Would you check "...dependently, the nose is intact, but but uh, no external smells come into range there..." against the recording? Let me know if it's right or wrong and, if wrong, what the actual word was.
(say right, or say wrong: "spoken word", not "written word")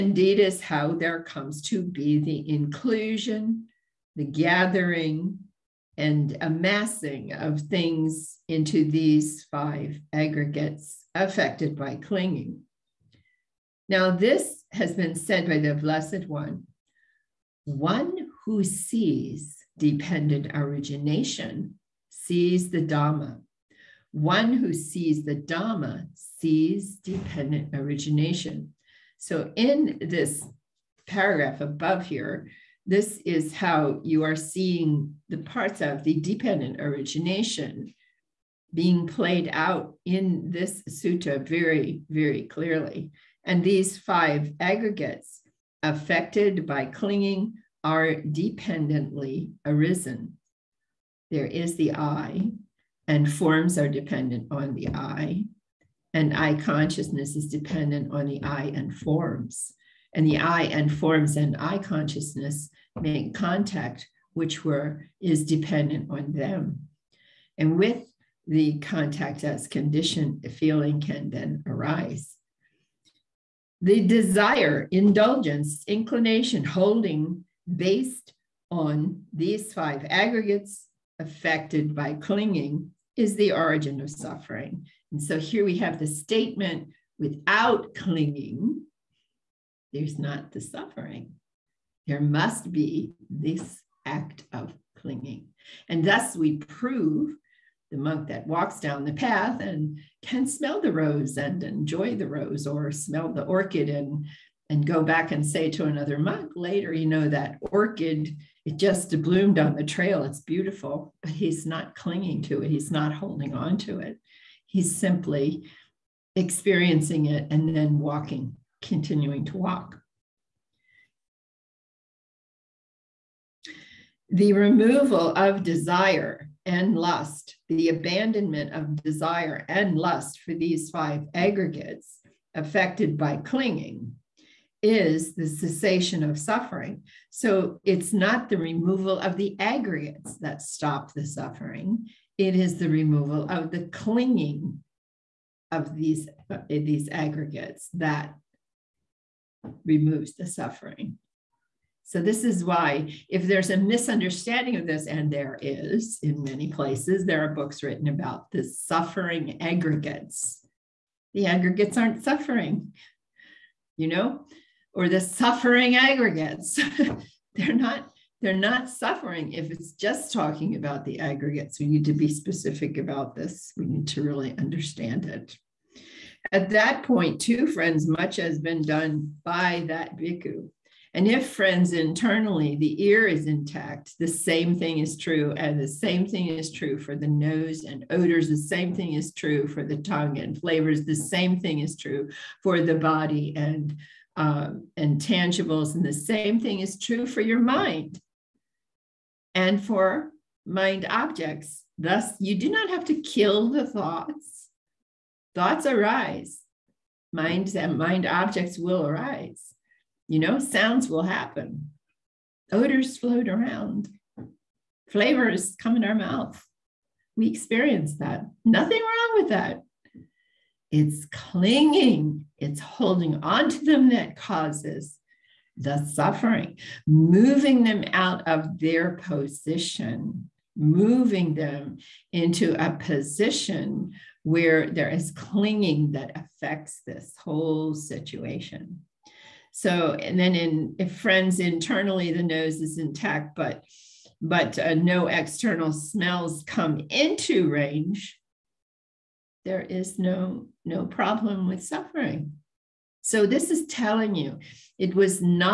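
wrong: "internally", not "dependently".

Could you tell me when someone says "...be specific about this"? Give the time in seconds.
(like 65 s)
172 s.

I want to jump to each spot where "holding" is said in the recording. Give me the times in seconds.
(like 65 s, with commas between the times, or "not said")
76 s, 113 s, 222 s.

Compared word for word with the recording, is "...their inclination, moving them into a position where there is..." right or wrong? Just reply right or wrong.
wrong.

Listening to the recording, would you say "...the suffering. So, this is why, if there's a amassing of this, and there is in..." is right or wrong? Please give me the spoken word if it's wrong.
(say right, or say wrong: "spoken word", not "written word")
wrong: "misunderstanding", not "amassing".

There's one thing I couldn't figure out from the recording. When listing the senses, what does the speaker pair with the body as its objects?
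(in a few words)
tangibles.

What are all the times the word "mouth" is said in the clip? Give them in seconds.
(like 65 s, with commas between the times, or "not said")
216 s.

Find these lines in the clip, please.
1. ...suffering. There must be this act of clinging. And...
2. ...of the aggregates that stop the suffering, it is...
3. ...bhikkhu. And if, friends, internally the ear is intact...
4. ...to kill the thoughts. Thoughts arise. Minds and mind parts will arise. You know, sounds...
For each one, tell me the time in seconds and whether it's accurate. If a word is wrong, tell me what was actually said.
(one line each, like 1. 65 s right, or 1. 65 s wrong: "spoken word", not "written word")
1. 90 s right
2. 139 s right
3. 180 s right
4. 203 s wrong: "objects", not "parts".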